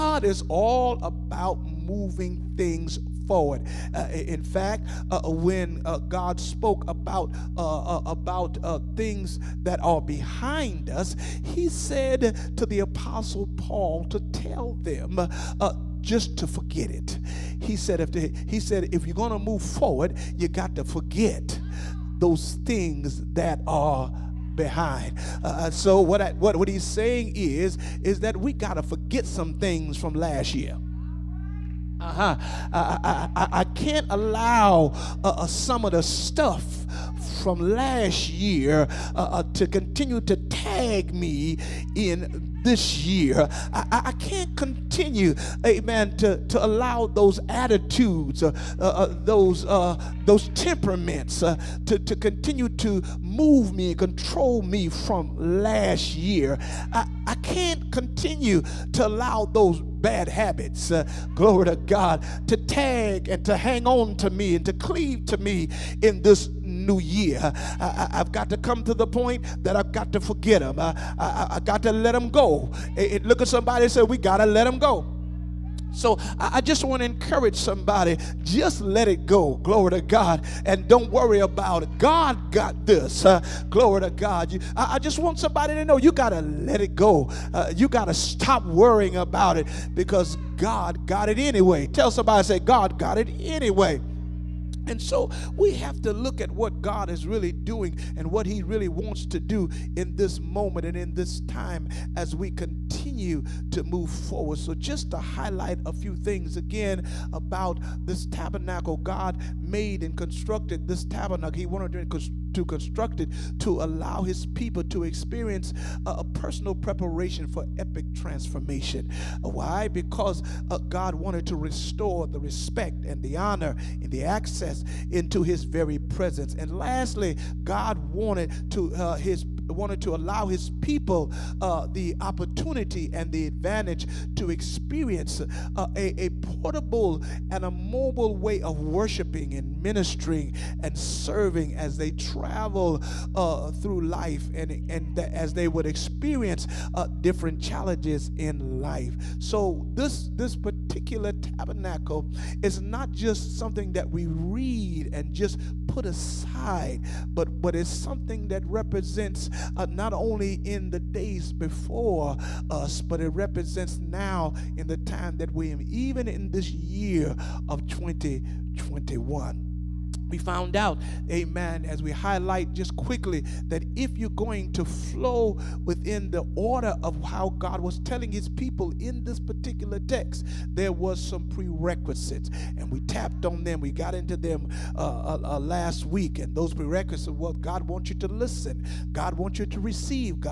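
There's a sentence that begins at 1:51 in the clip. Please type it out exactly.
He wanted to to construct it to allow his people to experience a, personal preparation for epic transformation.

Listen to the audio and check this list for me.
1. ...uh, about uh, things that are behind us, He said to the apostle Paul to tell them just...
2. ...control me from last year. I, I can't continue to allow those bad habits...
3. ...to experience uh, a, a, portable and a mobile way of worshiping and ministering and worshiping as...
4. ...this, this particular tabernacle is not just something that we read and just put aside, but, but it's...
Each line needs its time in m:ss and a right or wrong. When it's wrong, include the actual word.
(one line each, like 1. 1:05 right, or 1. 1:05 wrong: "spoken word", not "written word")
1. 0:07 right
2. 0:53 right
3. 2:14 wrong: "serving", not "worshiping"
4. 2:29 right.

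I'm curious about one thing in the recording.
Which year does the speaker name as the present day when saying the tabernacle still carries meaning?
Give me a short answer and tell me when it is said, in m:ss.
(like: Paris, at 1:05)
2021, at 2:47.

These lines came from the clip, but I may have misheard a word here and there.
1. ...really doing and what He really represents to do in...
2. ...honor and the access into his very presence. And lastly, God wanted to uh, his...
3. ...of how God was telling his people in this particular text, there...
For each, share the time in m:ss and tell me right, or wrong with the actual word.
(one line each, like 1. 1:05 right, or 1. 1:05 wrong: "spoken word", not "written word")
1. 1:37 wrong: "wants", not "represents"
2. 2:03 right
3. 2:57 right.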